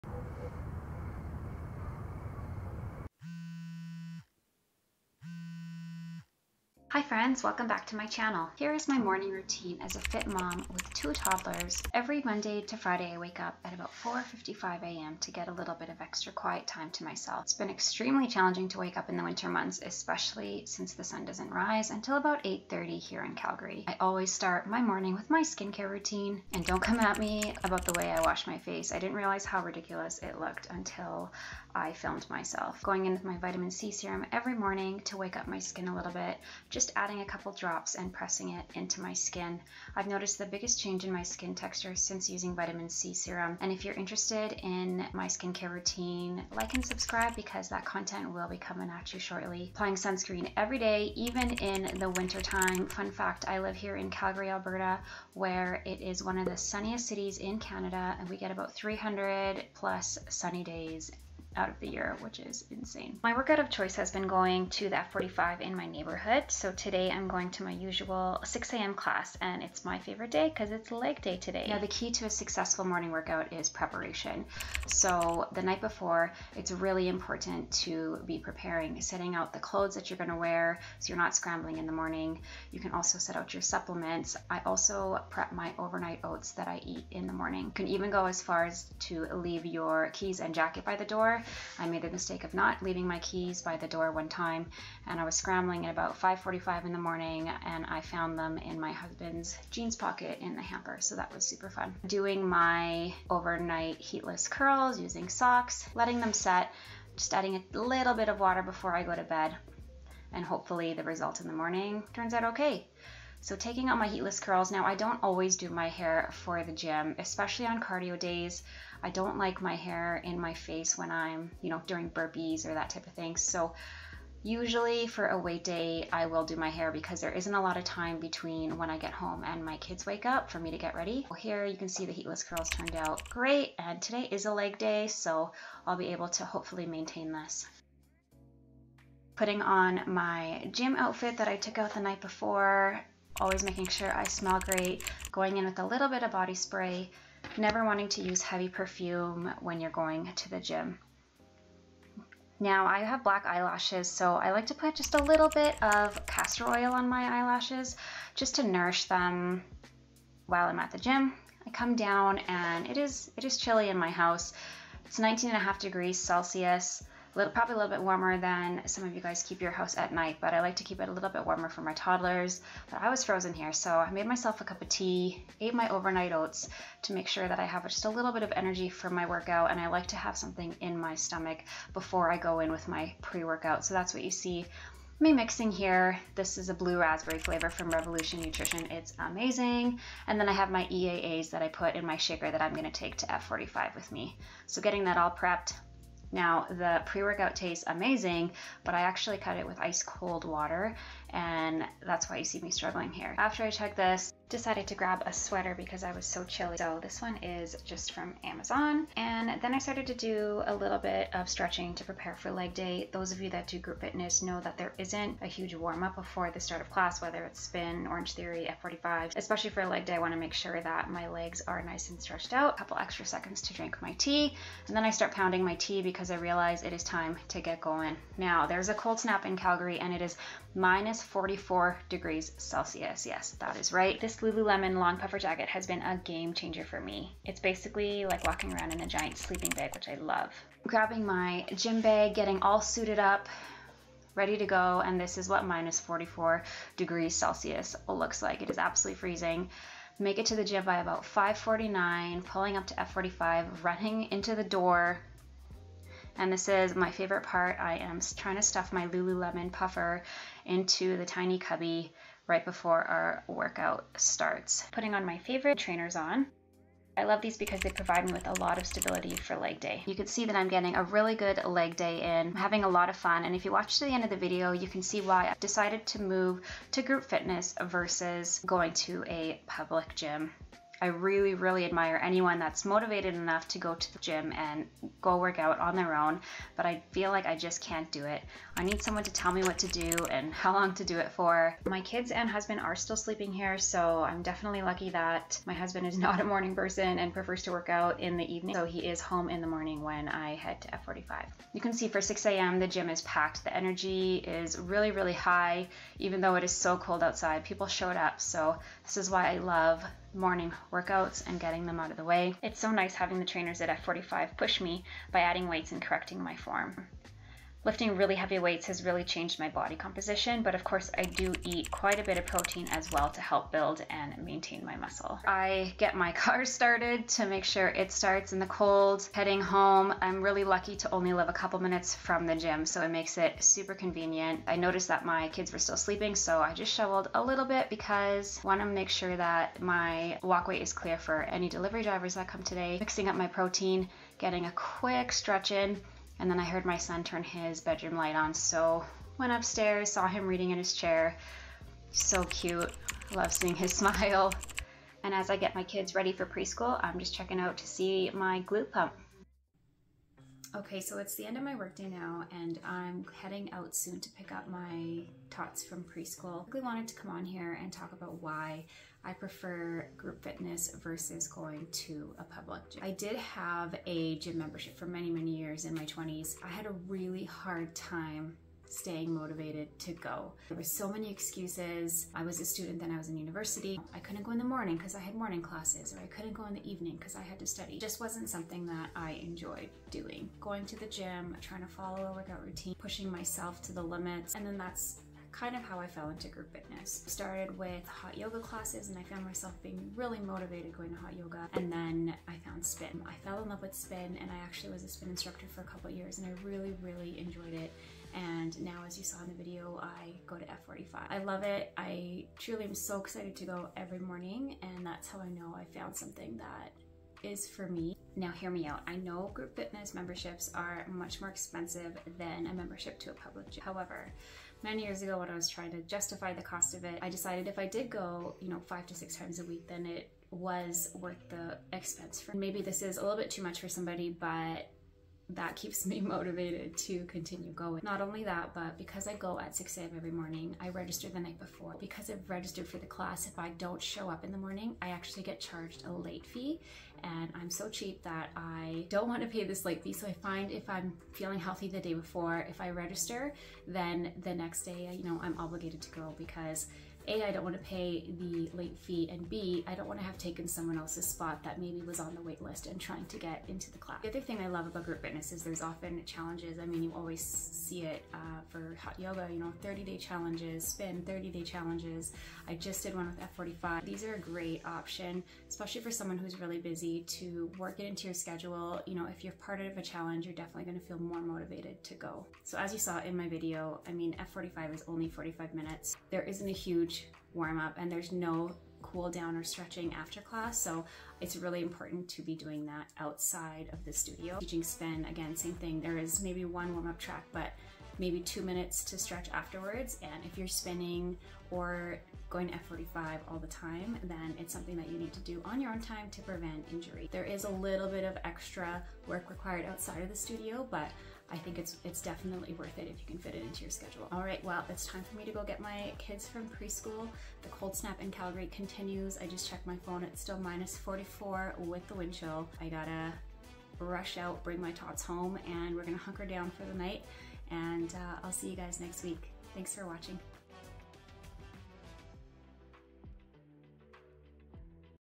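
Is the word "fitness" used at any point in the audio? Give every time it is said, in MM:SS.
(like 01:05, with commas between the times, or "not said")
03:34, 04:37, 06:10, 06:36, 06:59, 07:45.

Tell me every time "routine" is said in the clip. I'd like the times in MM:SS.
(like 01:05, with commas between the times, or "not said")
00:09, 00:25, 00:45, 06:32.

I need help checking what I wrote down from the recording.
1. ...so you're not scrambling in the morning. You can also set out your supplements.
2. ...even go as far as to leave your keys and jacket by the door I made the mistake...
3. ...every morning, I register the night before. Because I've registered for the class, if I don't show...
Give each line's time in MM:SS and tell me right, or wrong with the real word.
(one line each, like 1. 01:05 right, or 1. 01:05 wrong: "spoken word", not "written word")
1. 01:20 right
2. 01:27 right
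3. 07:20 right.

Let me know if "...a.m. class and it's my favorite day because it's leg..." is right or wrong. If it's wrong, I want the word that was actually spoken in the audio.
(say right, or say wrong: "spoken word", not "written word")
right.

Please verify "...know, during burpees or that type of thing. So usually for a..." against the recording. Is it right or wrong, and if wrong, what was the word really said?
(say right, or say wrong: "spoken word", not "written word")
right.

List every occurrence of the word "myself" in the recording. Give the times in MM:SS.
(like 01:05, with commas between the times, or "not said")
00:17, 00:32, 02:54, 06:33, 06:39.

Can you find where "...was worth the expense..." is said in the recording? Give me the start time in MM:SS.
07:10.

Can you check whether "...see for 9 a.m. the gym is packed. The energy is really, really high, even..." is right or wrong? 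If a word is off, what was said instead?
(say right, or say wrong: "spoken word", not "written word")
wrong: "6", not "9".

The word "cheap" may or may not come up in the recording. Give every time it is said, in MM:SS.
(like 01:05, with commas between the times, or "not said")
07:27.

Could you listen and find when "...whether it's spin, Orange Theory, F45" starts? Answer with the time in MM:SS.
03:37.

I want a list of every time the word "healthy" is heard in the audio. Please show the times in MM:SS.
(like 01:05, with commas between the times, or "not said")
07:31.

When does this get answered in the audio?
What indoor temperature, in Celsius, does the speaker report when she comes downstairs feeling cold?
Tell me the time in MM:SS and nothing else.
02:45.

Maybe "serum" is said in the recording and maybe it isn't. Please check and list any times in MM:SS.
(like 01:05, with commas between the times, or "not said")
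00:33, 00:43.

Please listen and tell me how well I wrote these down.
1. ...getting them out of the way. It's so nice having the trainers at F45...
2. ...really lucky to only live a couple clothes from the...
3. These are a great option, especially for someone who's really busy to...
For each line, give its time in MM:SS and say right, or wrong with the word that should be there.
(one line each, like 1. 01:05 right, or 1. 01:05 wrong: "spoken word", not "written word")
1. 05:11 right
2. 05:30 wrong: "minutes", not "clothes"
3. 07:54 right.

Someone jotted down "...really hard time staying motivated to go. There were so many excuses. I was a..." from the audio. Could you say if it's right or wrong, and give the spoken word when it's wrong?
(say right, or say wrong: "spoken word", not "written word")
right.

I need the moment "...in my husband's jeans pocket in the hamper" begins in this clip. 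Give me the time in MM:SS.
01:38.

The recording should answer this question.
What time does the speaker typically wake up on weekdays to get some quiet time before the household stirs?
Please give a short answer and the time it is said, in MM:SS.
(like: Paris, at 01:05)
4:55 a.m., at 00:14.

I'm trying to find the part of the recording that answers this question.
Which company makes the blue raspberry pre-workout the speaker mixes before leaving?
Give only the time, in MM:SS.
03:07.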